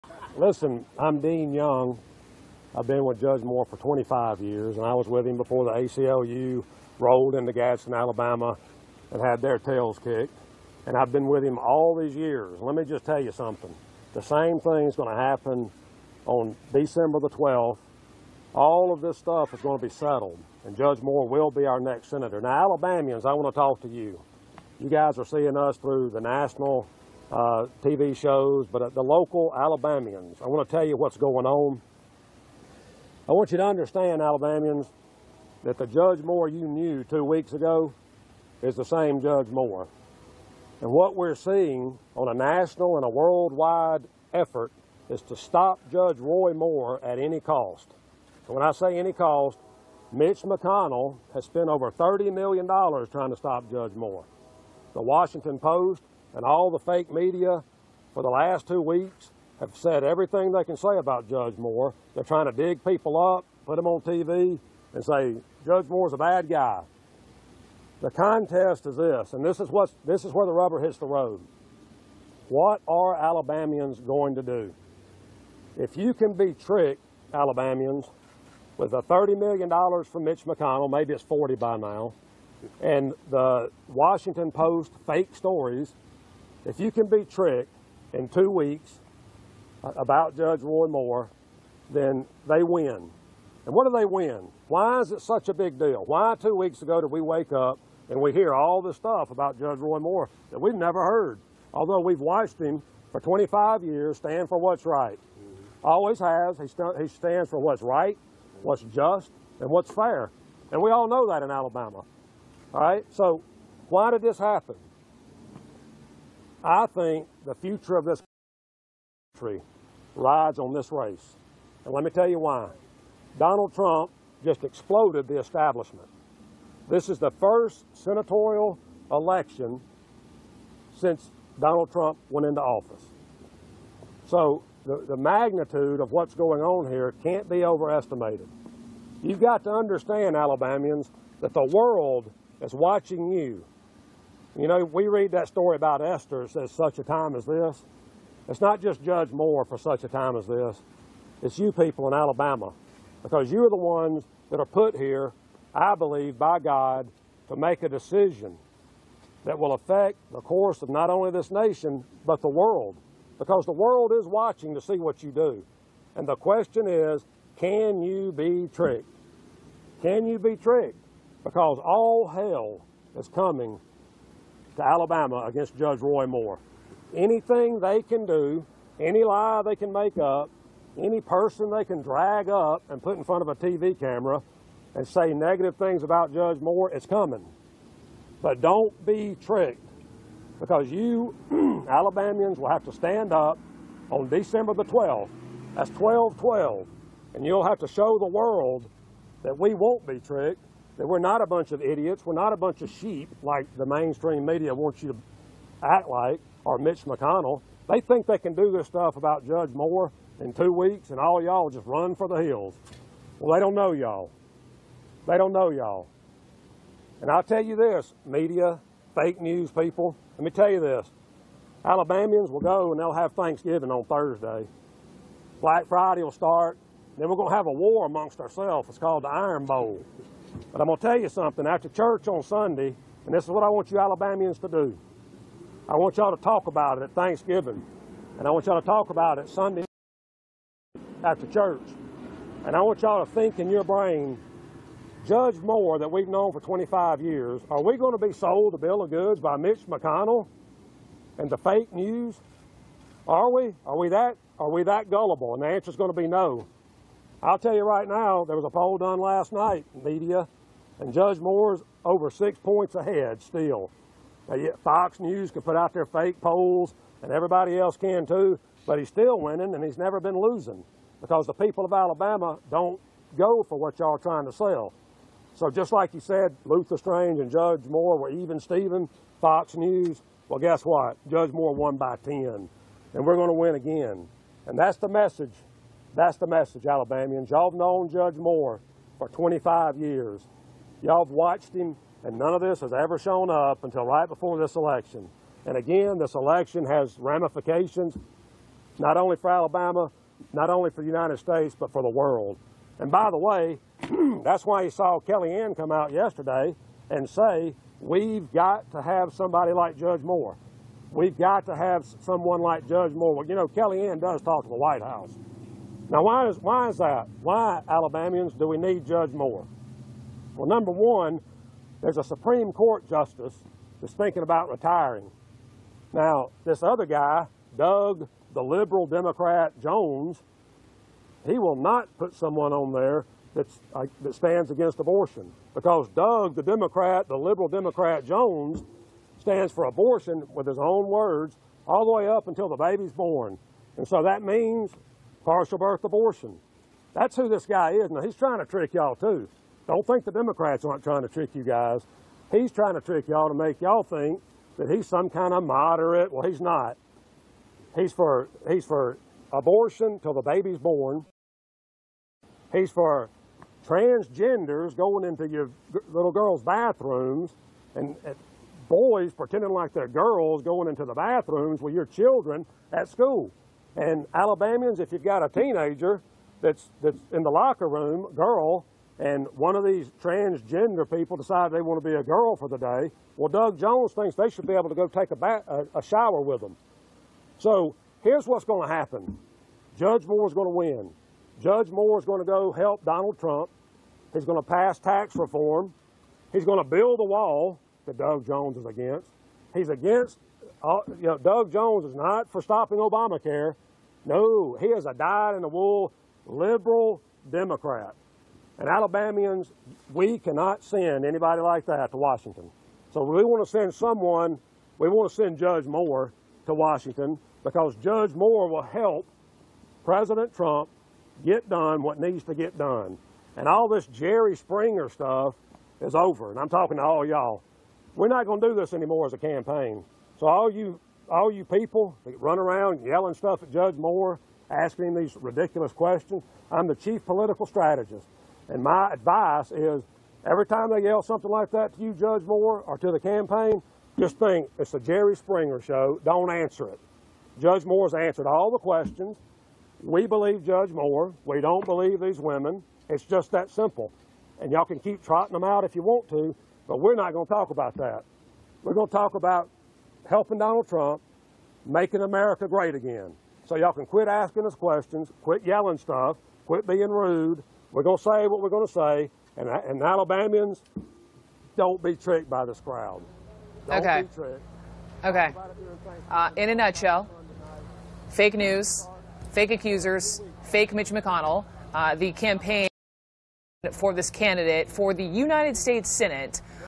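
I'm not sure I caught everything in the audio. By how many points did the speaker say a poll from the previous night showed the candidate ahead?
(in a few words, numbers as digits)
6 points.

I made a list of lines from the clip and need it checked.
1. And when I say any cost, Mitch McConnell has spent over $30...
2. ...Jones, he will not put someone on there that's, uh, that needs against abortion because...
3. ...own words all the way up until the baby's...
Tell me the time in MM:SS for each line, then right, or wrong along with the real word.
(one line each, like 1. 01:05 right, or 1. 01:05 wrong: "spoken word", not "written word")
1. 00:48 right
2. 05:29 wrong: "stands", not "needs"
3. 05:40 right.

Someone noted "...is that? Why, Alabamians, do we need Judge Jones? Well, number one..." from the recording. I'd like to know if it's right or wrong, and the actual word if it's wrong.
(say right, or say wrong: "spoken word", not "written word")
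wrong: "Moore", not "Jones".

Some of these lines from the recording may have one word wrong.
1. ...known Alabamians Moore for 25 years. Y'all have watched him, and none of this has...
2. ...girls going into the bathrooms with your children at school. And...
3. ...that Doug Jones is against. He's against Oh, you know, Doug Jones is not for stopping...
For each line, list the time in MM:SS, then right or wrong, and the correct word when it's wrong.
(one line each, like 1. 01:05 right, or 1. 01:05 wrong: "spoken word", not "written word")
1. 04:47 wrong: "Judge", not "Alabamians"
2. 06:10 right
3. 06:38 right.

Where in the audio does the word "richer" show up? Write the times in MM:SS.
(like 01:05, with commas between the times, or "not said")
not said.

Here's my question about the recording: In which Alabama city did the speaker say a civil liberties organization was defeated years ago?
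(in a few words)
Gadsden.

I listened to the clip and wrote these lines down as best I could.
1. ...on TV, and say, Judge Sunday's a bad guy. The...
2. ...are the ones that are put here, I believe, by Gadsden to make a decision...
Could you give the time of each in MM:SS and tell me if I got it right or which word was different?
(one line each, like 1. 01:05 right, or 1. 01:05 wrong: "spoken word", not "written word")
1. 01:03 wrong: "Moore", not "Sunday"
2. 02:33 wrong: "God", not "Gadsden".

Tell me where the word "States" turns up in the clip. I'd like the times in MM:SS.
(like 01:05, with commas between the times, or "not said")
05:01, 08:05.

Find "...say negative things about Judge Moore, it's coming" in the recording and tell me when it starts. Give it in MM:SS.
03:05.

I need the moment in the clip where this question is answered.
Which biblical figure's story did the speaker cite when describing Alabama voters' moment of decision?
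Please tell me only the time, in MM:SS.
02:26.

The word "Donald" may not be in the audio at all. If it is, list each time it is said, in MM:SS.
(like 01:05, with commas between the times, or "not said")
02:03, 02:11, 06:33, 07:40.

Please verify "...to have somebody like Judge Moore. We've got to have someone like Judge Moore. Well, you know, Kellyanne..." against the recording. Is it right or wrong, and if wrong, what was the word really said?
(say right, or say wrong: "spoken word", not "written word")
right.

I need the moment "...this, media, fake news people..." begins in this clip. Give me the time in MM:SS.
03:37.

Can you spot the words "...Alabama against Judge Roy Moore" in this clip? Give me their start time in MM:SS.
02:54.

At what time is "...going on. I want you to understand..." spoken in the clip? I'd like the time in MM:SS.
00:31.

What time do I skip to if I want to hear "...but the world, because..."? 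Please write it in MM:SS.
02:42.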